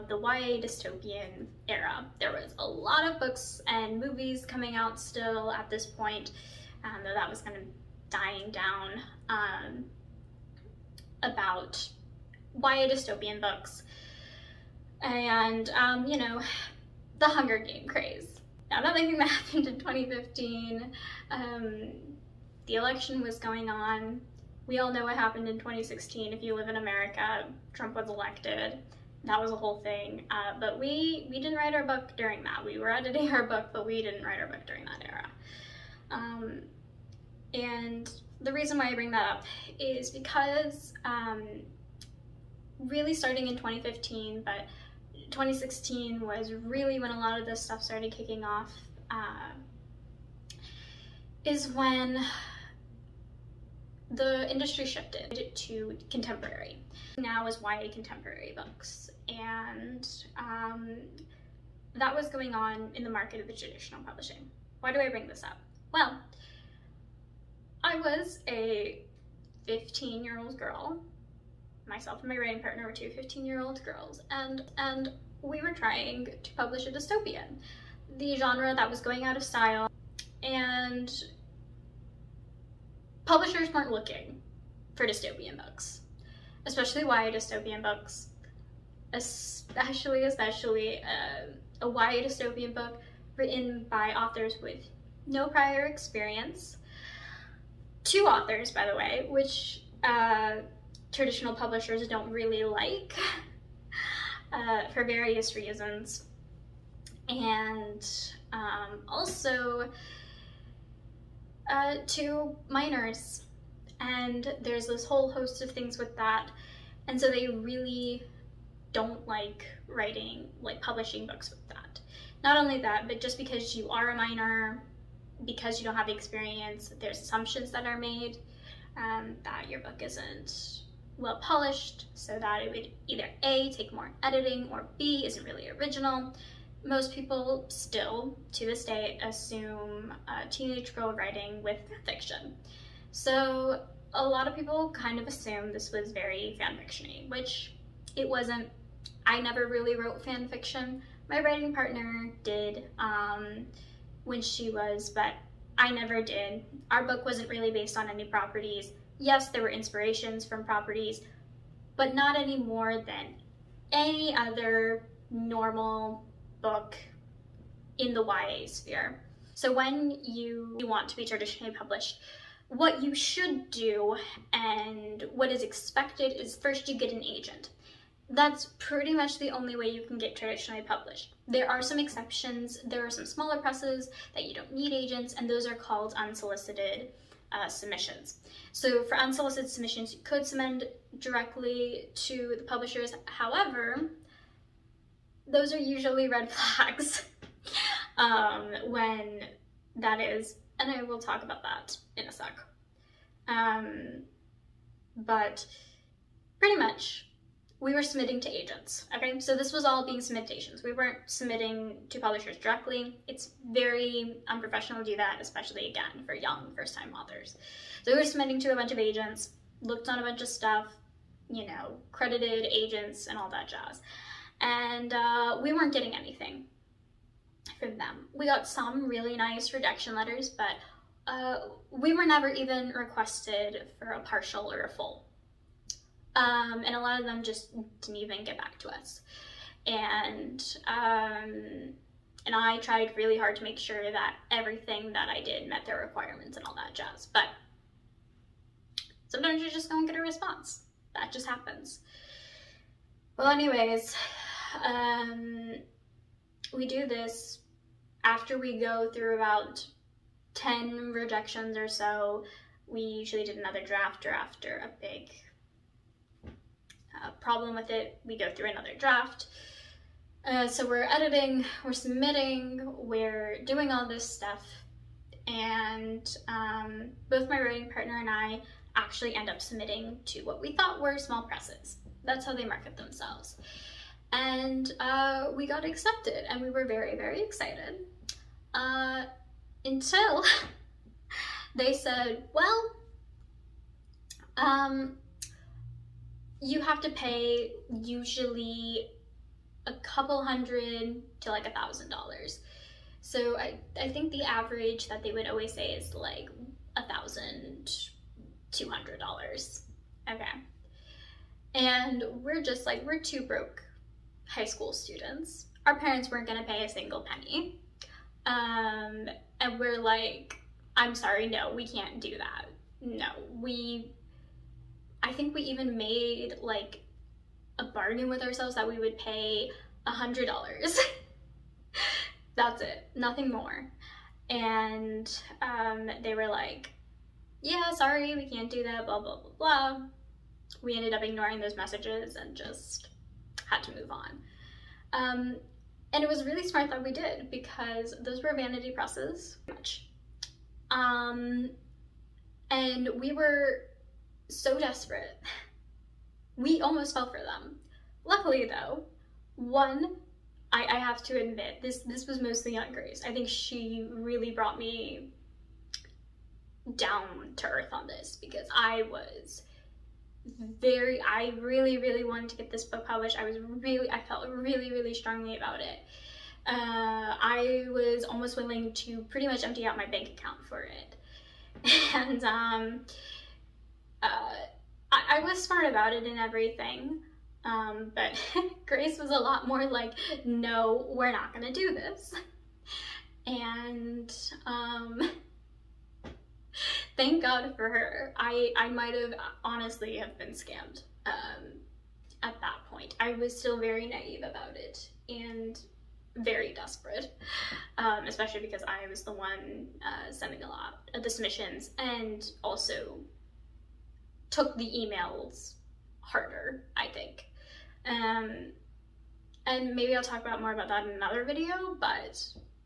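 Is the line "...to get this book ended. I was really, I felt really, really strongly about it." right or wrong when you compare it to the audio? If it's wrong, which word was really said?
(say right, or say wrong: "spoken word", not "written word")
wrong: "published", not "ended".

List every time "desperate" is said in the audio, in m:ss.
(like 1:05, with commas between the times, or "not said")
5:54, 6:46.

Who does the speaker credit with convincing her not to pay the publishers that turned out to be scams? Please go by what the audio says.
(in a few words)
Aunt Grace.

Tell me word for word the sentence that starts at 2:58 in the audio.
That's pretty much the only way you can get traditionally published.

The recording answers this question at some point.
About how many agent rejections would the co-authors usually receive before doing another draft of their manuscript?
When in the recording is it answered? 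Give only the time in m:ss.
4:20.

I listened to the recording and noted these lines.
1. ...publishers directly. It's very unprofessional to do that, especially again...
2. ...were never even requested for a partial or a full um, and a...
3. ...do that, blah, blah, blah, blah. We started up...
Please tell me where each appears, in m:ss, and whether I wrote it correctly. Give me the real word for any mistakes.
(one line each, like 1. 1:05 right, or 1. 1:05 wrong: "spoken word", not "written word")
1. 3:32 right
2. 3:52 right
3. 5:38 wrong: "ended", not "started".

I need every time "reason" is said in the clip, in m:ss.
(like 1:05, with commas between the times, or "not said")
0:38, 1:45.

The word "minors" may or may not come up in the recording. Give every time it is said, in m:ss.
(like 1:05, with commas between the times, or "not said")
1:52, 2:04.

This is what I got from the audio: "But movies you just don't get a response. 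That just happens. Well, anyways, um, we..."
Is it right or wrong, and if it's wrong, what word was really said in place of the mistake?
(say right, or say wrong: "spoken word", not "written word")
wrong: "sometimes", not "movies".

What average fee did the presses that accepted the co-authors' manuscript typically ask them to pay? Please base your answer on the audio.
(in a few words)
$1,200.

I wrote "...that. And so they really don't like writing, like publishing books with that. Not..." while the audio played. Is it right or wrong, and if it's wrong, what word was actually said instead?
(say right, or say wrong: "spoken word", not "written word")
right.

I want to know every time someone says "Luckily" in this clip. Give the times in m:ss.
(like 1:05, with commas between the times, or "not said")
5:58.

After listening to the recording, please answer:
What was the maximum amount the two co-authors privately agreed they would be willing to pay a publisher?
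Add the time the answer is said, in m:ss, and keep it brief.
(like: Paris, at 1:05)
$100, at 5:30.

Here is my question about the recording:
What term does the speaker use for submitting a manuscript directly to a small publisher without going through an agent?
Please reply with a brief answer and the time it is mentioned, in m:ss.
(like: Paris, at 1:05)
Unsolicited submissions, at 3:06.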